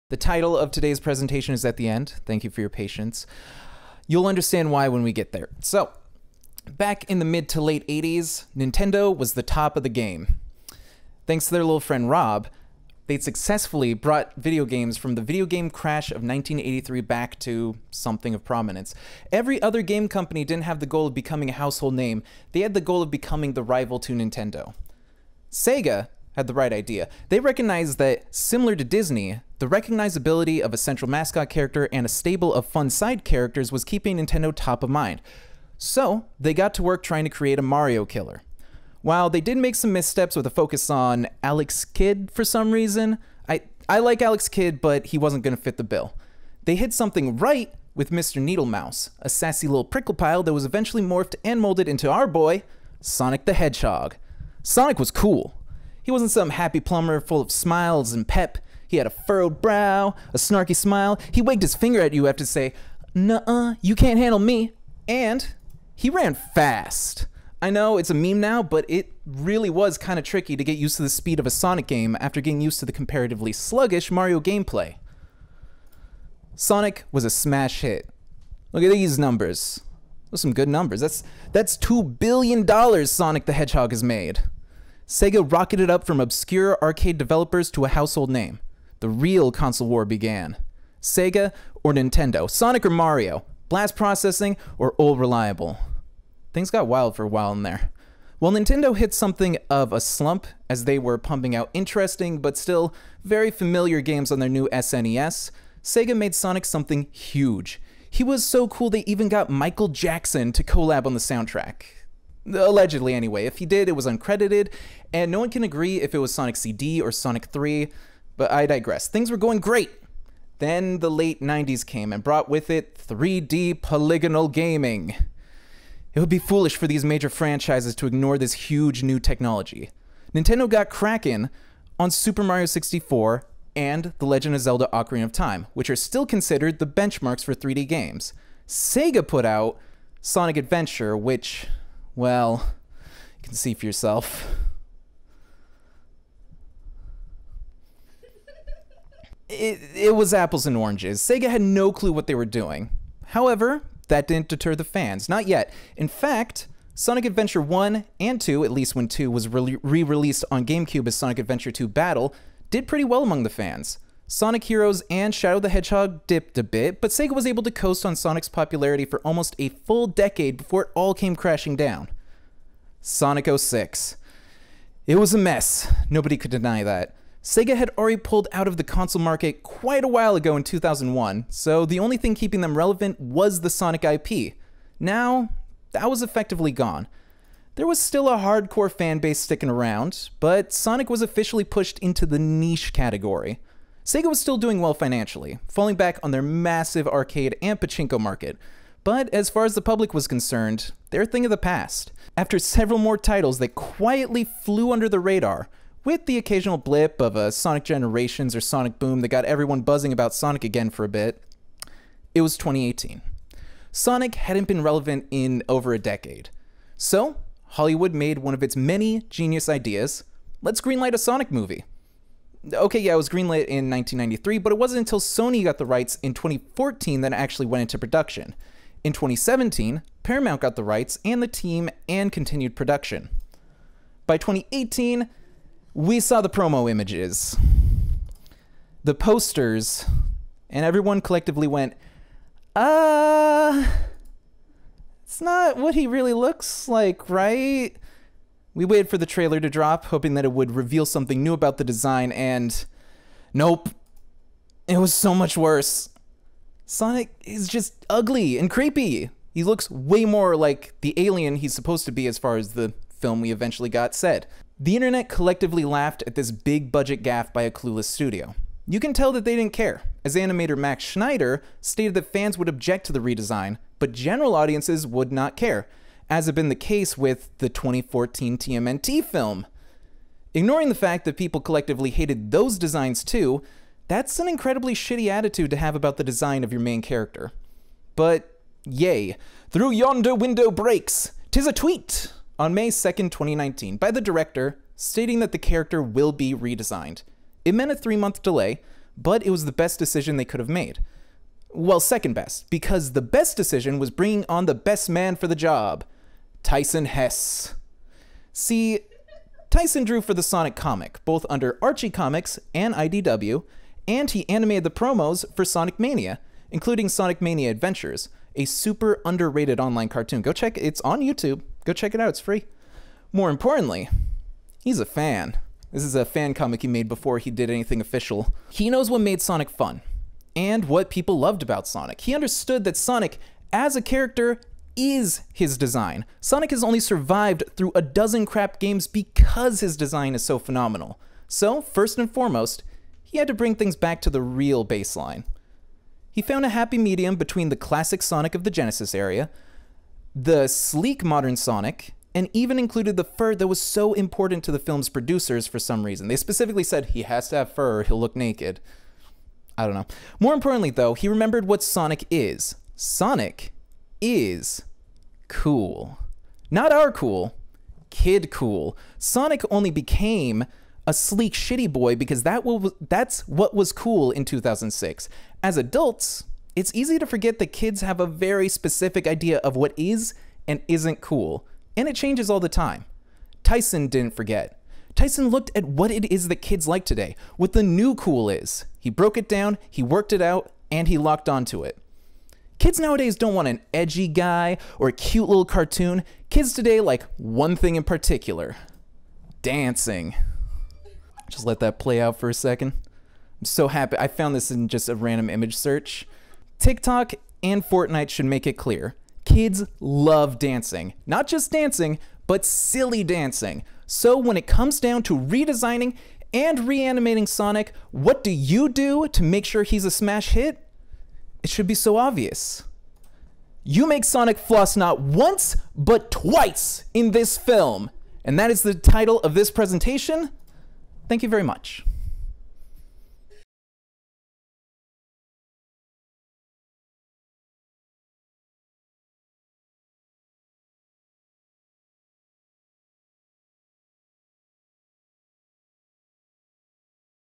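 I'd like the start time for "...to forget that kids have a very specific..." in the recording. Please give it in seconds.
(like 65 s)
377 s.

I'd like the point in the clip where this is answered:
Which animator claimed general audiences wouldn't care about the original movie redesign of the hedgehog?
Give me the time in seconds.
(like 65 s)
270 s.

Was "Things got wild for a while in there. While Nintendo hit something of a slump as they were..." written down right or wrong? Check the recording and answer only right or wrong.
right.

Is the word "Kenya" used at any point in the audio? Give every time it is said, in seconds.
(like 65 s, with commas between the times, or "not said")
not said.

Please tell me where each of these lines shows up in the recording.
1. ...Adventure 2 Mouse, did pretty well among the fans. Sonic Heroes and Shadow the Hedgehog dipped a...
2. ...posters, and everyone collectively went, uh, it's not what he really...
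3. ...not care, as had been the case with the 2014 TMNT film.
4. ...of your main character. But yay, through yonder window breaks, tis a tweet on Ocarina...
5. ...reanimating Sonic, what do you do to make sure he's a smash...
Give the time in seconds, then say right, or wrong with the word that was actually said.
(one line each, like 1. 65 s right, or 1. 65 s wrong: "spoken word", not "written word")
1. 161 s wrong: "Battle", not "Mouse"
2. 239 s right
3. 275 s right
4. 286 s wrong: "May", not "Ocarina"
5. 416 s right.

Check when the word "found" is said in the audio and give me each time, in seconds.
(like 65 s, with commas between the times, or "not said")
346 s, 404 s.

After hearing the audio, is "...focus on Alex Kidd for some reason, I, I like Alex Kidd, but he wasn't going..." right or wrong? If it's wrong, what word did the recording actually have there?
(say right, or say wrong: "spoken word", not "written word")
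right.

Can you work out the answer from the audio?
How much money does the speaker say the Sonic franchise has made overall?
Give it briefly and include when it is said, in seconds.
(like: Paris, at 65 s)
2 billion dollars, at 81 s.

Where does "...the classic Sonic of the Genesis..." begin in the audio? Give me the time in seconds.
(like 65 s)
347 s.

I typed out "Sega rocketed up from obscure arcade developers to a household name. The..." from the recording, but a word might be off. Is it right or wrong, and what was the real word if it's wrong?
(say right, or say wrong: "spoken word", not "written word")
right.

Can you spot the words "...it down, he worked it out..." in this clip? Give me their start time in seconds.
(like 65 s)
389 s.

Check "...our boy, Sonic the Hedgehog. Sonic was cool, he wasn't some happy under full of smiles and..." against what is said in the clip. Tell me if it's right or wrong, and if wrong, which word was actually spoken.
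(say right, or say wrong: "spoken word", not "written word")
wrong: "plumber", not "under".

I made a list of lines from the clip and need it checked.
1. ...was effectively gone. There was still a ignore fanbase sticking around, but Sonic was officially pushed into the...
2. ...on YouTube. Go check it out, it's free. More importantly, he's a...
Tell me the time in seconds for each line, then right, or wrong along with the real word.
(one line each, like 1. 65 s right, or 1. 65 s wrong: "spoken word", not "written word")
1. 186 s wrong: "hardcore", not "ignore"
2. 321 s right.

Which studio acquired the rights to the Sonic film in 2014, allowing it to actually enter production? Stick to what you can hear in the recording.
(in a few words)
Sony.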